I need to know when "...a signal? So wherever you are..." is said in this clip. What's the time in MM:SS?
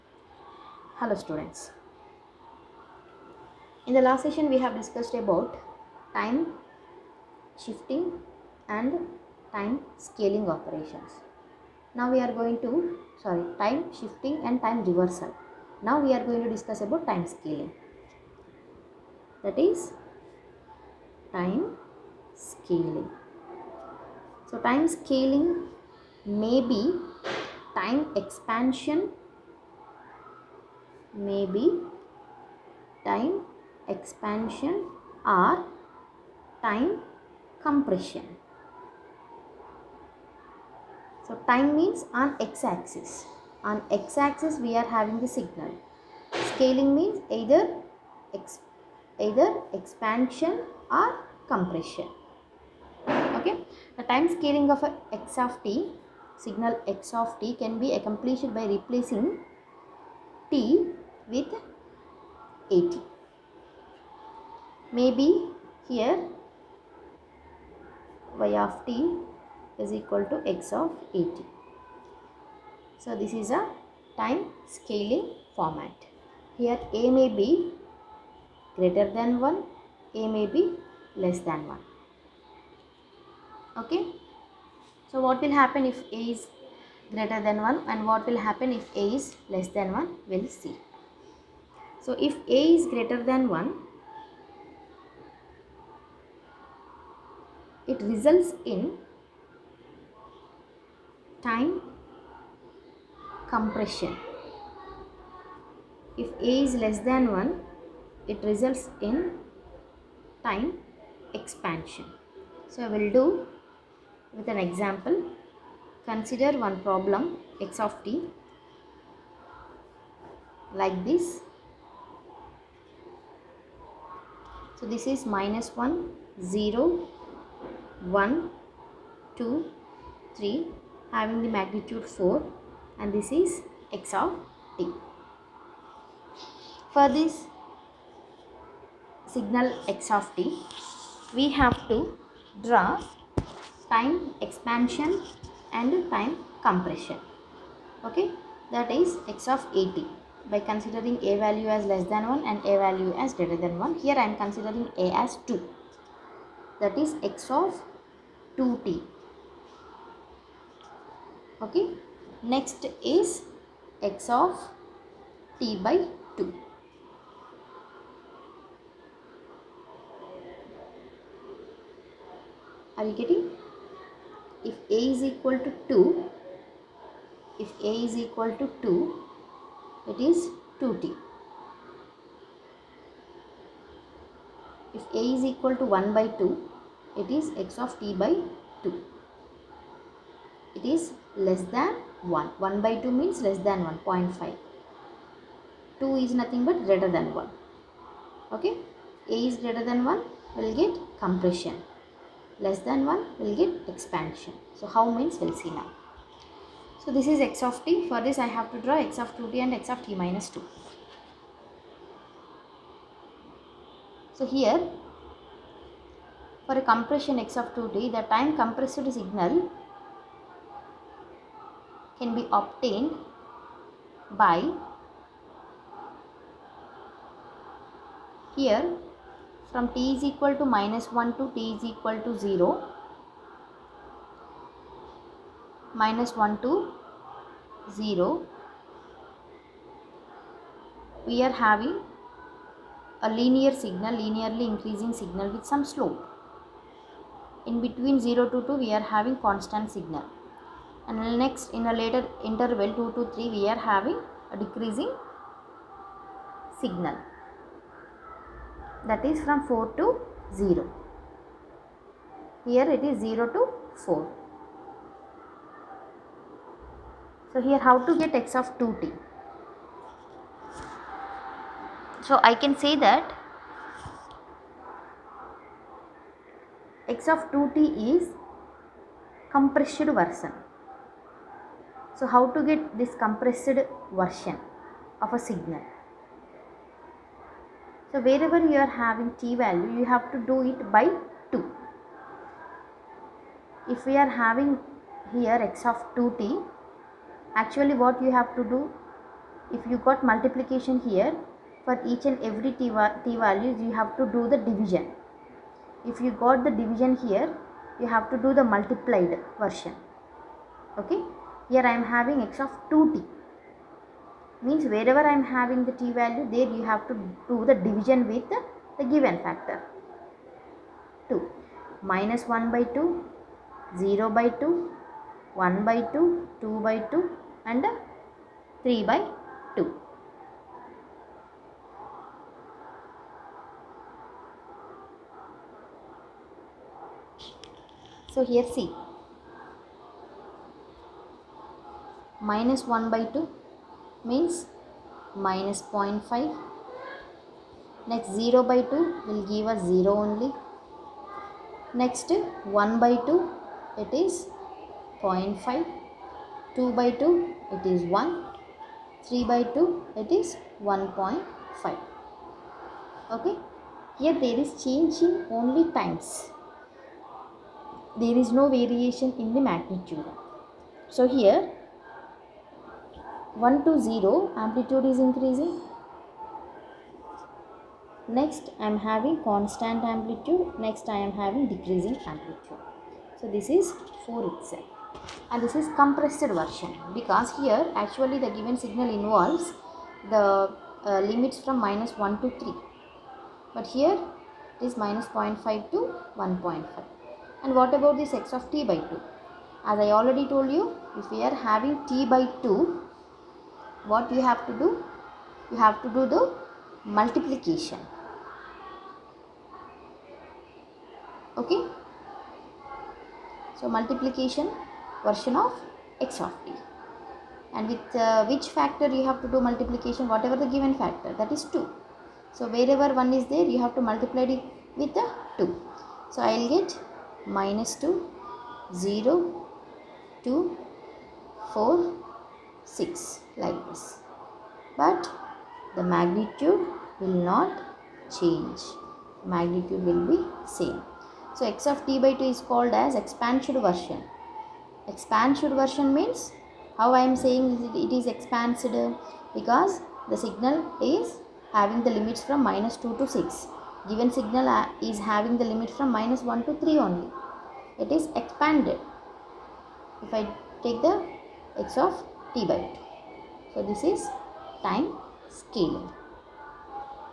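04:45.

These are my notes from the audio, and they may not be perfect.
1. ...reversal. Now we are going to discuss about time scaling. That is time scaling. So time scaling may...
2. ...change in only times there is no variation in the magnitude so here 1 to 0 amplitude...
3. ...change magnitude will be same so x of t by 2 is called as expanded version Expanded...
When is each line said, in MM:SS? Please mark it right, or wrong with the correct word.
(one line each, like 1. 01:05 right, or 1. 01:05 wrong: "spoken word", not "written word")
1. 00:14 right
2. 06:04 right
3. 07:18 right.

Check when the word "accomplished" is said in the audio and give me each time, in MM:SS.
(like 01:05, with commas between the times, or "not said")
00:57.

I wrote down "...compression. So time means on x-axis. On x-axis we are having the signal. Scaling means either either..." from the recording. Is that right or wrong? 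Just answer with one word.
right.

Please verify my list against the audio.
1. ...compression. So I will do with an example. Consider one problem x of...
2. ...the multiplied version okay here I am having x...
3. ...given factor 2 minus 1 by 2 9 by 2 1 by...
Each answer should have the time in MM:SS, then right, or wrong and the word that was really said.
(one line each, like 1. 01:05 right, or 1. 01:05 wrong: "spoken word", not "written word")
1. 01:51 wrong: "expansion", not "compression"
2. 05:08 right
3. 05:19 wrong: "0", not "9".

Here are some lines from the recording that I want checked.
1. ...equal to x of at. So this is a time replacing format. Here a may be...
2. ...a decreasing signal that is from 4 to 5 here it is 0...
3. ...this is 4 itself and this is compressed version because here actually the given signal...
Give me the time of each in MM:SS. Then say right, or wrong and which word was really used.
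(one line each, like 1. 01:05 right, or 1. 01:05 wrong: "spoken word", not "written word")
1. 01:09 wrong: "scaling", not "replacing"
2. 04:14 wrong: "0", not "5"
3. 06:23 right.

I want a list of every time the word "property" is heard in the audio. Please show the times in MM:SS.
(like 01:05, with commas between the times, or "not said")
not said.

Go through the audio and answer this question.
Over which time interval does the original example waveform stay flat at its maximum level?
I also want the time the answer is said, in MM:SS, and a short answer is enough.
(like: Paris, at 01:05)
0 to 2, at 04:07.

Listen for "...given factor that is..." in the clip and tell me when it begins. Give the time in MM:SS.
07:00.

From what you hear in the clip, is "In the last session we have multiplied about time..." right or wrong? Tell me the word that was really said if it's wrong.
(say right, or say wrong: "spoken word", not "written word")
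wrong: "discussed", not "multiplied".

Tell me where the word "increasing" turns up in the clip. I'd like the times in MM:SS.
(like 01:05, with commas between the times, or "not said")
04:04, 06:15.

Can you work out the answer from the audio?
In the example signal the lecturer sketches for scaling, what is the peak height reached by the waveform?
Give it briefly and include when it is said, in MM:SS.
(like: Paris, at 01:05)
4, at 02:11.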